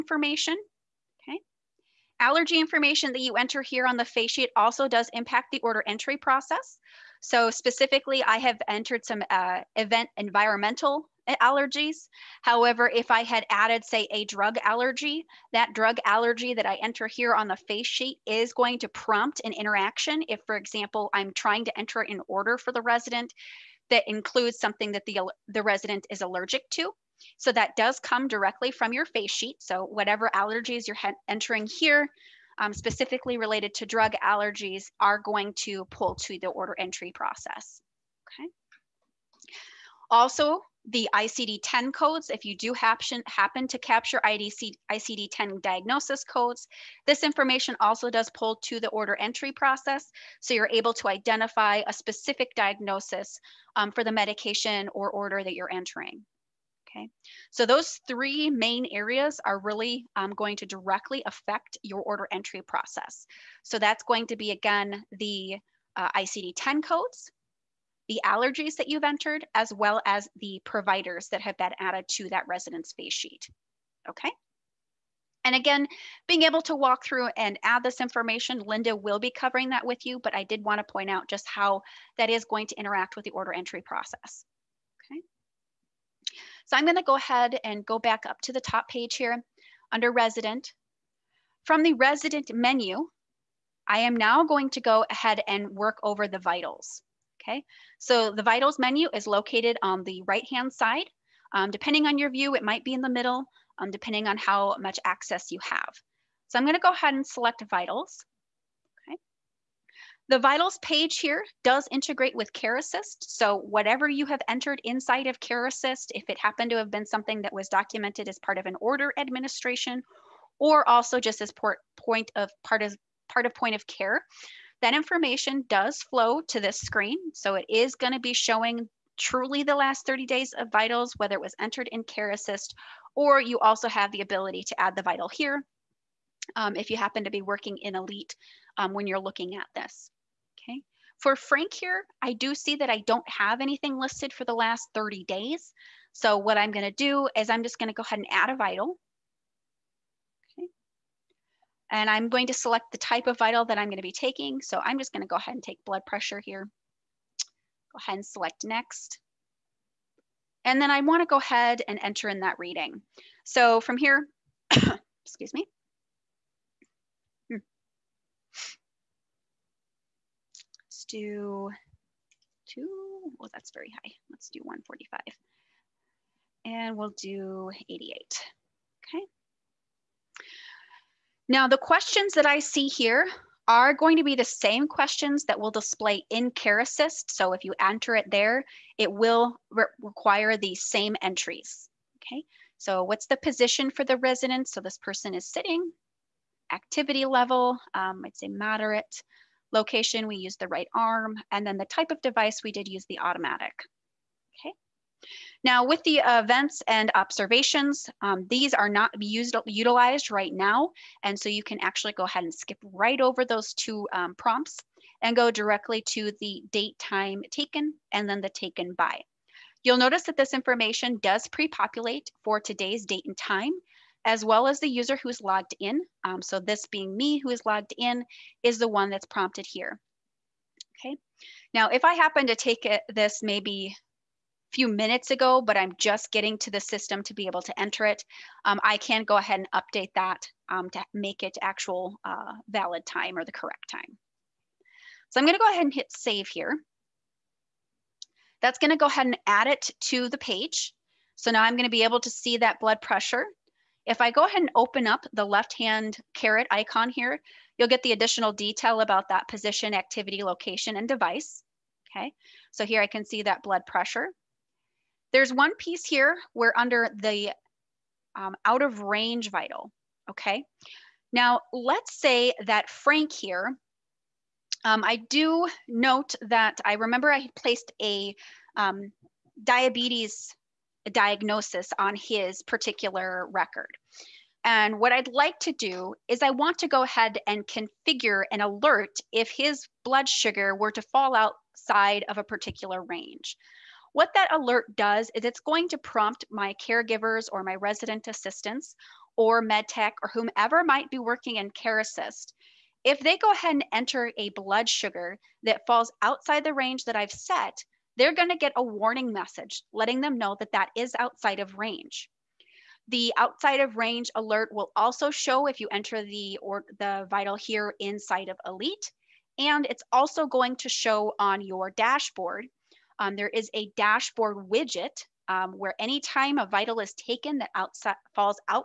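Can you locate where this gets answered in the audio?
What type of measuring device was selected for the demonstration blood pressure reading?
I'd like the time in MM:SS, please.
03:23.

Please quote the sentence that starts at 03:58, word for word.
Um, I can go ahead and update that um, to make it actual uh, valid time or the correct time.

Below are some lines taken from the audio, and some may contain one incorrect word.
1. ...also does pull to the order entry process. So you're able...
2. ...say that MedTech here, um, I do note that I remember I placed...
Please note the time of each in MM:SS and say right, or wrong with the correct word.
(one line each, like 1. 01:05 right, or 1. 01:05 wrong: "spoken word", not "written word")
1. 00:47 right
2. 04:32 wrong: "Frank", not "MedTech".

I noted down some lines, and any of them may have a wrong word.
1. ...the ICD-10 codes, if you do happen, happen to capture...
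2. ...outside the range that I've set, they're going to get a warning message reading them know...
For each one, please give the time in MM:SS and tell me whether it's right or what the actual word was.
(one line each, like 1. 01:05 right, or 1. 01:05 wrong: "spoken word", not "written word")
1. 00:40 right
2. 05:06 wrong: "letting", not "reading".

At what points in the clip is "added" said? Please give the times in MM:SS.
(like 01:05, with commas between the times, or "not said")
00:13, 01:11.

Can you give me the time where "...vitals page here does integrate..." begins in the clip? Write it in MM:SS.
01:50.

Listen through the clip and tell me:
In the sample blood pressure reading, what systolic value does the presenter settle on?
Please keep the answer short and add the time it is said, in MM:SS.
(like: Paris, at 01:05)
145, at 02:54.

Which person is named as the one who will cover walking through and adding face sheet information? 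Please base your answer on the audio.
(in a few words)
Linda.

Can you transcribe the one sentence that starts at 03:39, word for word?
You'll notice that this information does pre-populate for today's date and time, as well as the user who's logged in.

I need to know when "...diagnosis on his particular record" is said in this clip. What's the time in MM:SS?
04:41.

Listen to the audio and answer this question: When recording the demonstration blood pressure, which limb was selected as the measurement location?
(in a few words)
Right arm.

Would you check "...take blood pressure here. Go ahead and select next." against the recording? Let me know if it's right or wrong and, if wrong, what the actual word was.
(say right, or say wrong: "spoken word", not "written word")
right.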